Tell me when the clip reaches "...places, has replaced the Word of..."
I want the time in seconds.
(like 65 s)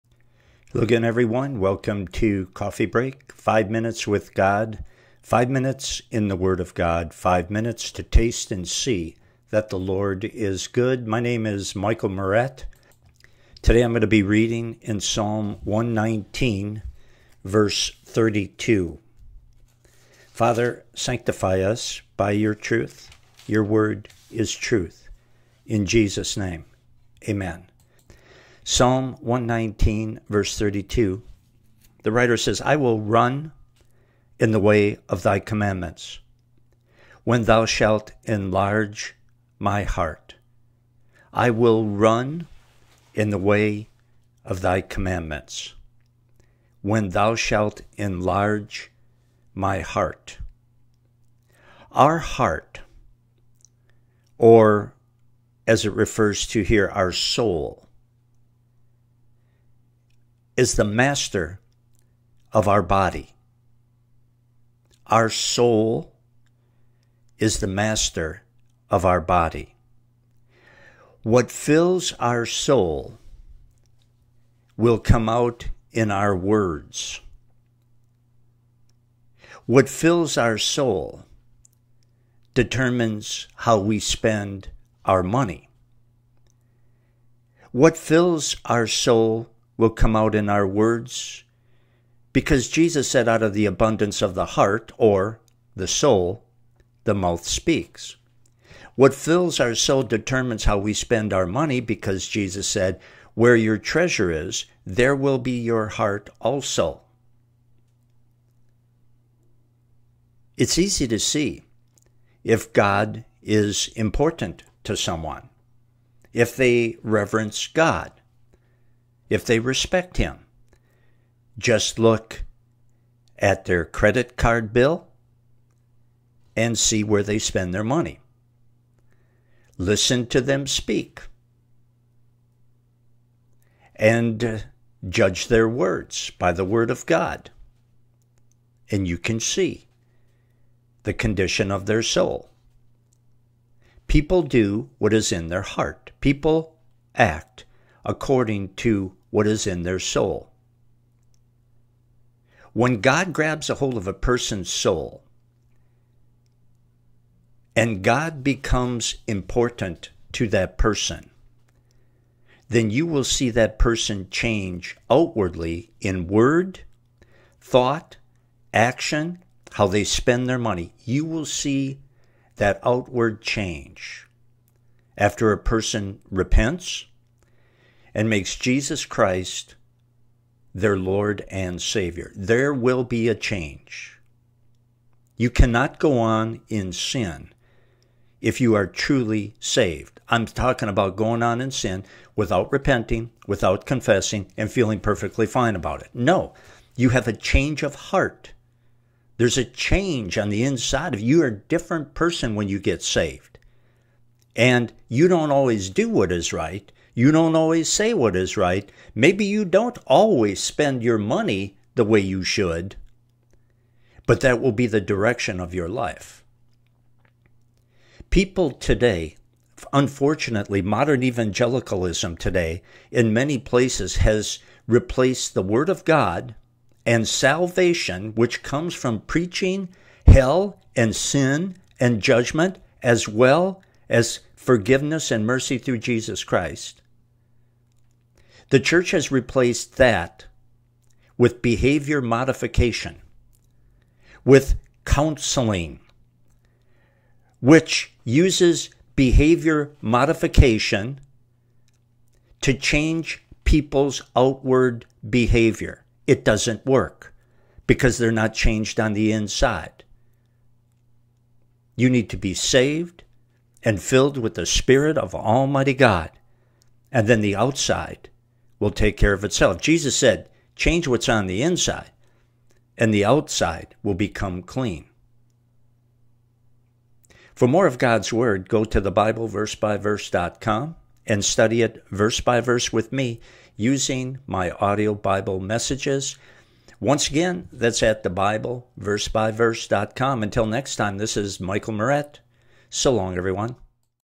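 223 s.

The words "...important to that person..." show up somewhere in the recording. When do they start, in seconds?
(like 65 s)
159 s.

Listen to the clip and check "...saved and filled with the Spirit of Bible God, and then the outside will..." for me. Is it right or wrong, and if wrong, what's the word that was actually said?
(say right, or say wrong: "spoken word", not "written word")
wrong: "Almighty", not "Bible".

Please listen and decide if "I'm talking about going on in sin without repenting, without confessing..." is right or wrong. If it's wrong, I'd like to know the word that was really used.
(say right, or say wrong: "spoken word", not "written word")
right.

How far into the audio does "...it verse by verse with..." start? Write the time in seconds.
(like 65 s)
281 s.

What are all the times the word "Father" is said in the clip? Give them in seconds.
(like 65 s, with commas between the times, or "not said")
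20 s.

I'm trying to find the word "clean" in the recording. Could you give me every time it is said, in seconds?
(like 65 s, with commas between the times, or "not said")
274 s.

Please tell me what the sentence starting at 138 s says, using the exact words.
And you can see the condition of their soul.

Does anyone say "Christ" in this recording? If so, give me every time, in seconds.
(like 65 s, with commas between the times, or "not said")
179 s, 236 s.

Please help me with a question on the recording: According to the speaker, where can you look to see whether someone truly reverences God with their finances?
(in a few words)
Credit card bill.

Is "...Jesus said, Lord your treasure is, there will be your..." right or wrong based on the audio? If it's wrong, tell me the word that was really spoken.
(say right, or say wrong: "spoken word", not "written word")
wrong: "Where", not "Lord".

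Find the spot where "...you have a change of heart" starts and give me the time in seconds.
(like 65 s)
196 s.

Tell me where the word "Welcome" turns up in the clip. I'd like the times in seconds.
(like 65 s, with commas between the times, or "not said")
1 s.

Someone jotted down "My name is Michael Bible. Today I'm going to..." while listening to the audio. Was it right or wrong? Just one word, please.
wrong.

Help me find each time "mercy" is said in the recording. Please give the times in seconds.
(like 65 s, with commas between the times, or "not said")
235 s.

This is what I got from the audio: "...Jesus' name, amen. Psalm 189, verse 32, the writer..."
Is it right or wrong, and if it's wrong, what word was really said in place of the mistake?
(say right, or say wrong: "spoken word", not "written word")
wrong: "119", not "189".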